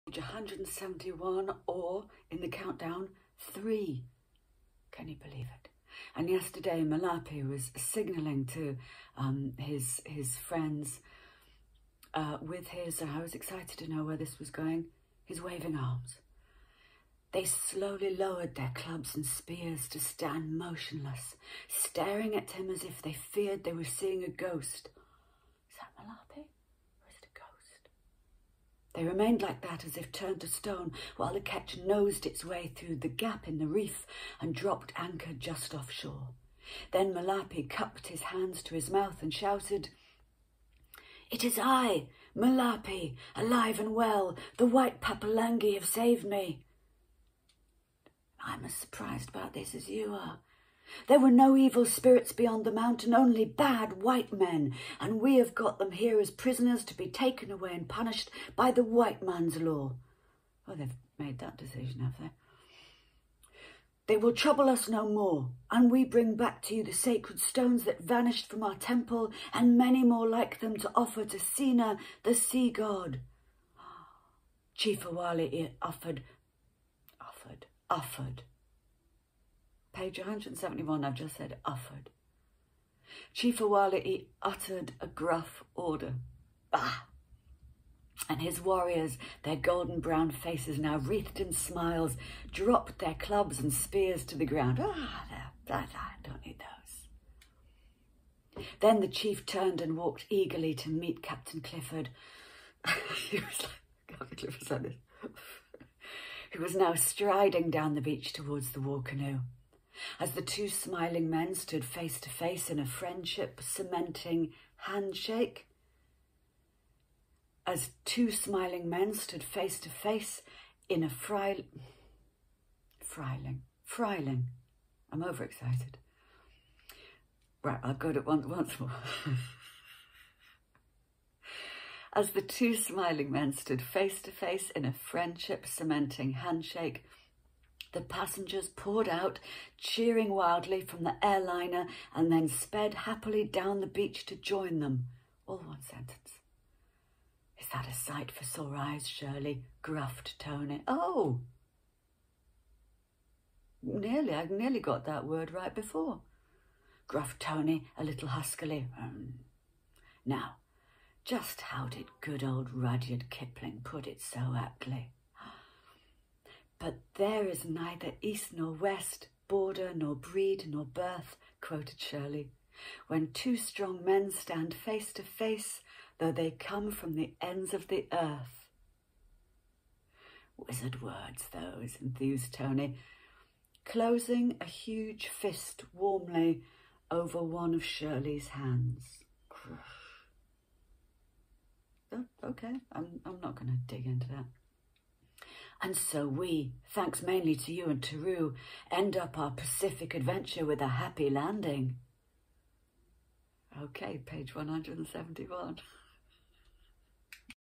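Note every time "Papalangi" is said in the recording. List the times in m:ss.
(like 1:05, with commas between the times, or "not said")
0:44.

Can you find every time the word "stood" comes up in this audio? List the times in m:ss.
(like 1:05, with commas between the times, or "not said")
1:51, 1:59, 2:13.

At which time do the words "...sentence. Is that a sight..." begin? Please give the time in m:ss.
2:25.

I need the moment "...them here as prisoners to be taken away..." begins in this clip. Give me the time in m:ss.
0:55.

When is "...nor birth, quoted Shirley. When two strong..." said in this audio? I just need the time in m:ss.
2:50.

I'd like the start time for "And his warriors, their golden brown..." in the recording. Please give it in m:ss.
1:28.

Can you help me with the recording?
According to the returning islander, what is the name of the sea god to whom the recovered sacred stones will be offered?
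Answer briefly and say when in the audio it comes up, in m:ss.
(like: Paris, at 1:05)
Sina, at 1:11.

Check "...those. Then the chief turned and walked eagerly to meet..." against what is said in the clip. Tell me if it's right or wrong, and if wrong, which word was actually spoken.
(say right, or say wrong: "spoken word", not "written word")
right.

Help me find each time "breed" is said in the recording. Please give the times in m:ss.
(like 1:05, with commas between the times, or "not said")
2:50.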